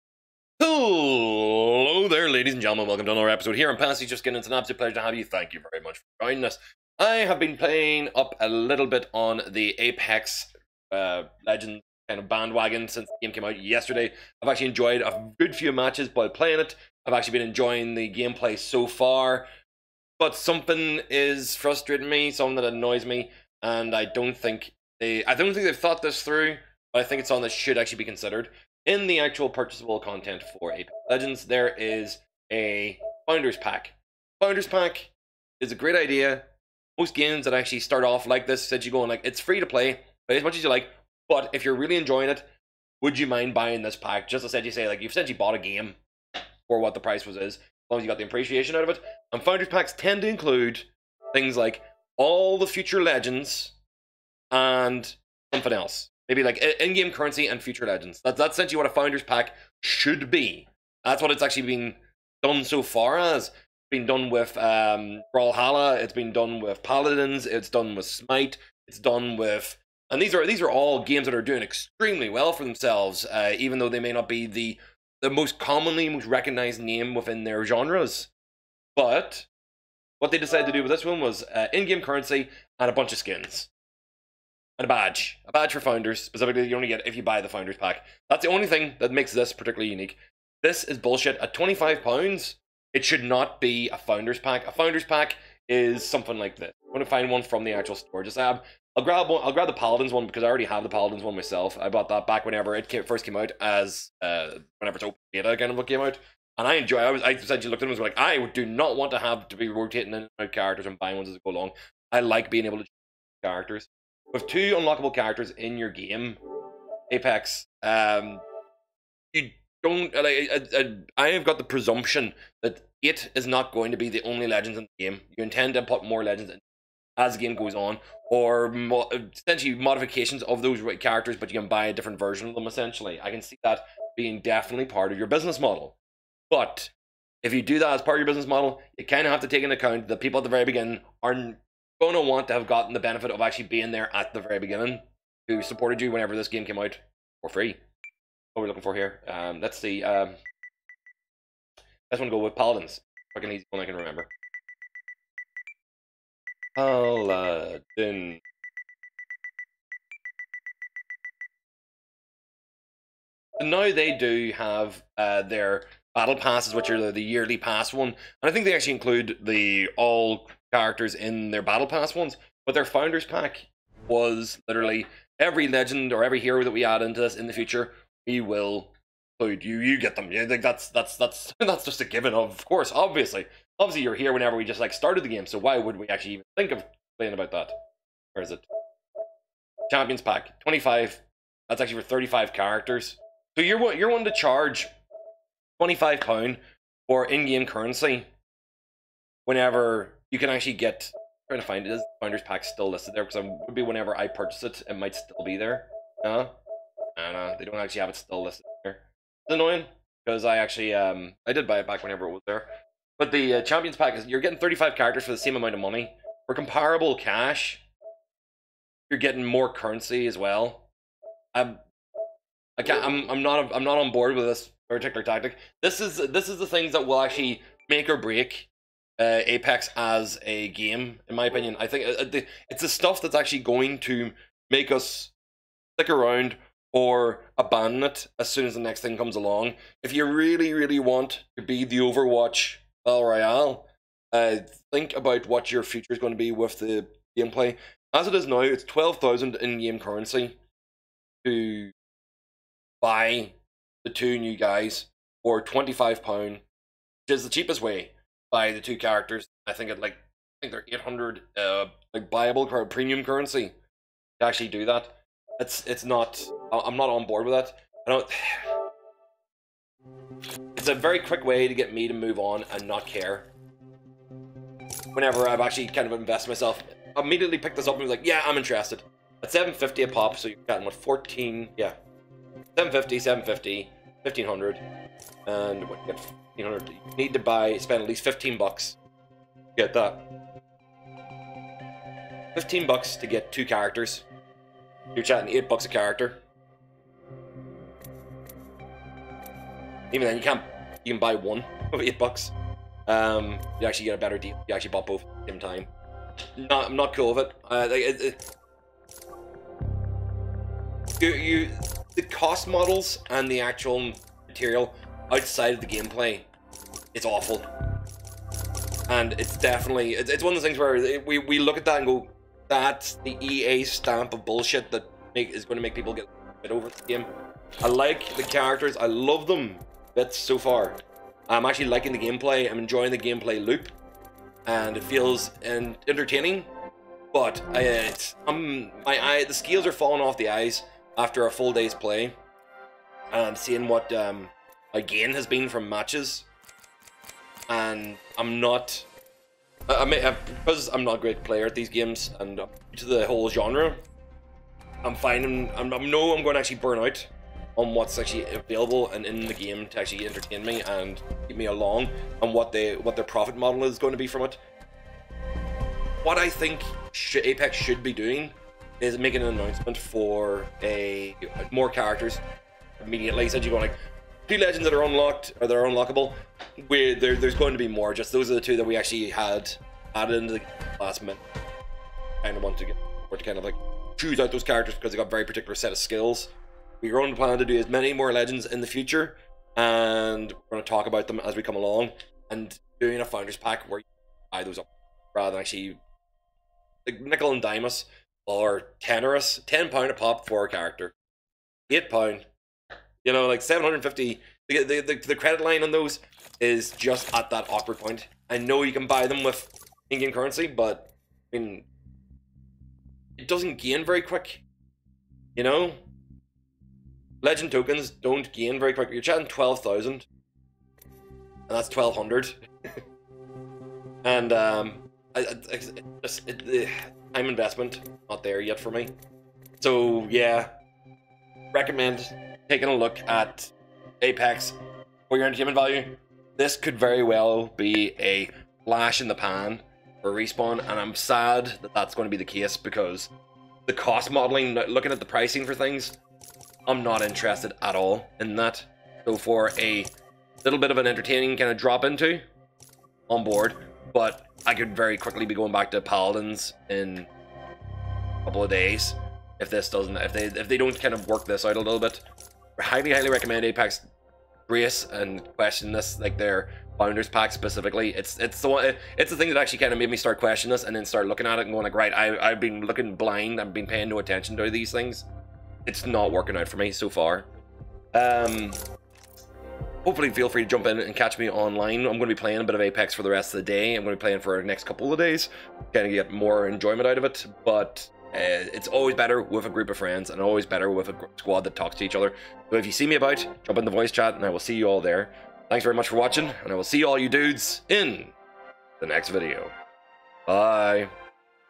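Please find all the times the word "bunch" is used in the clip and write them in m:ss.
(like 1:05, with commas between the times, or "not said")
1:22.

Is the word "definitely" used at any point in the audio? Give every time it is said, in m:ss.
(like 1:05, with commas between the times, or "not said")
2:14, 5:19.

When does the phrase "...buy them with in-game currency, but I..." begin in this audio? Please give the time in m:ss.
6:49.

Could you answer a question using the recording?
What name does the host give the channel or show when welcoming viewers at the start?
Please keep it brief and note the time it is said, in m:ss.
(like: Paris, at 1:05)
Pastiche of Skin, at 0:03.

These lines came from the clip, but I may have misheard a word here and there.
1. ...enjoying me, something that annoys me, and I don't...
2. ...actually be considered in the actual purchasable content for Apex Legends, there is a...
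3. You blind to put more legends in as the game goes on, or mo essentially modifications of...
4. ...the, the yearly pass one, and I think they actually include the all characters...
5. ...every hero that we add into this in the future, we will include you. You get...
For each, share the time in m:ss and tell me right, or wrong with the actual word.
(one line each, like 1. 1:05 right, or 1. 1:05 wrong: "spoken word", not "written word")
1. 0:21 wrong: "frustrating", not "enjoying"
2. 0:27 right
3. 2:05 wrong: "intend", not "blind"
4. 2:46 right
5. 2:56 right.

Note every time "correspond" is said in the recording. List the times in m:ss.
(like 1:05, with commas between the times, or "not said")
not said.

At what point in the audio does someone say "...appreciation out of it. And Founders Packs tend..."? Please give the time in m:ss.
0:48.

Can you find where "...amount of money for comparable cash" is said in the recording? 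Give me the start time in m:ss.
3:35.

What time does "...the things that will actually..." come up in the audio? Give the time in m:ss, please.
3:46.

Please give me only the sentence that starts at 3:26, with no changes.
No, They don't actually have it still listed there.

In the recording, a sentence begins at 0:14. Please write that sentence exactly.
I've actually enjoyed a good few matches while playing it.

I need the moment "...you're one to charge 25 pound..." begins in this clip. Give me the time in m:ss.
3:13.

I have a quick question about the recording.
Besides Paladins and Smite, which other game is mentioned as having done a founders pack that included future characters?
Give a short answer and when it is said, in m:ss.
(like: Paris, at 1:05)
Brawlhalla, at 1:05.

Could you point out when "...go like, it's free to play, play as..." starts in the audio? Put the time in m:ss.
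0:38.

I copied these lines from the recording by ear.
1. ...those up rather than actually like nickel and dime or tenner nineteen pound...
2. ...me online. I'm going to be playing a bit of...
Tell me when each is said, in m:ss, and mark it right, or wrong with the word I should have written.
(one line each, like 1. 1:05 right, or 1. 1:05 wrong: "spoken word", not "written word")
1. 6:34 wrong: "ten", not "nineteen"
2. 8:01 right.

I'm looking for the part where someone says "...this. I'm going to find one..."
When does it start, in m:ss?
1:36.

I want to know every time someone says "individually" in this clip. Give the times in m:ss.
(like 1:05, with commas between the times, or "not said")
not said.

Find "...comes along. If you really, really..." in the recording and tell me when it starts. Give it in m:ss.
3:59.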